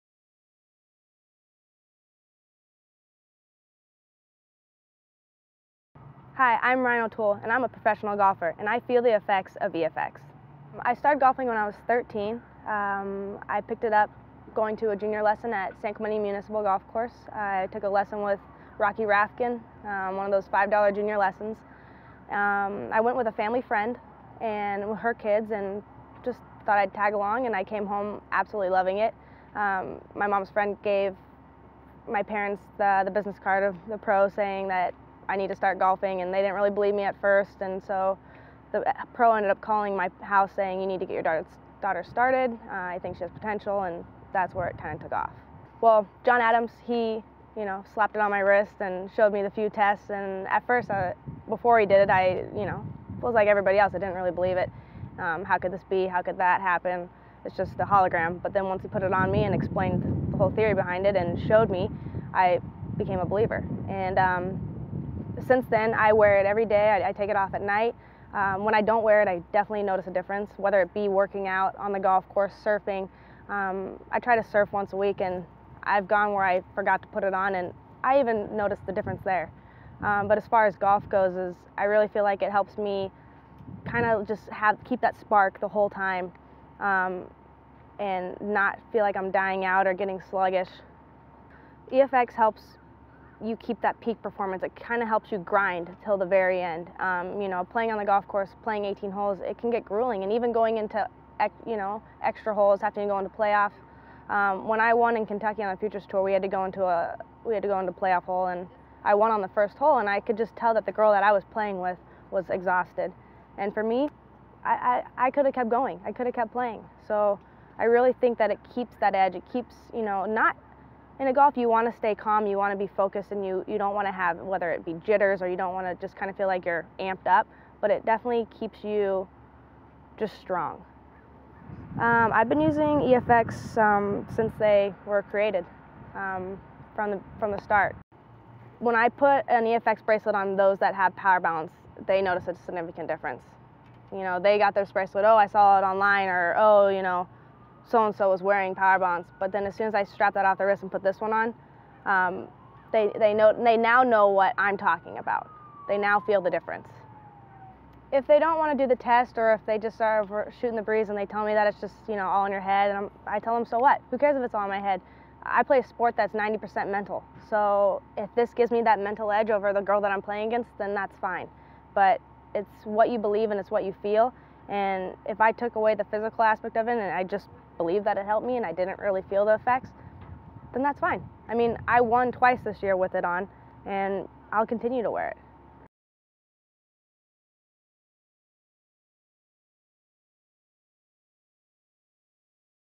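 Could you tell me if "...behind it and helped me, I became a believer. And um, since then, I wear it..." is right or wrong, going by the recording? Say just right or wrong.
wrong.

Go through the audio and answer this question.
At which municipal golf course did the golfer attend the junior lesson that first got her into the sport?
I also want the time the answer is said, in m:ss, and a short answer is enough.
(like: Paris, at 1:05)
San Clemente, at 0:15.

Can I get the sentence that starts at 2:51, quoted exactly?
But it's what you believe and it's what you feel.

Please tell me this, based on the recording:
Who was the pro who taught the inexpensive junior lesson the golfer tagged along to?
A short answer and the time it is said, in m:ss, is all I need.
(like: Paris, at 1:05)
Rocky Rafkin, at 0:18.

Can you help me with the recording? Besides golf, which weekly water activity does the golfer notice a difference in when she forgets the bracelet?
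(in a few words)
surfing.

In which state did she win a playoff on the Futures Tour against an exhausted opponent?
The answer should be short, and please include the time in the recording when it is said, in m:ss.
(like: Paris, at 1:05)
Kentucky, at 1:45.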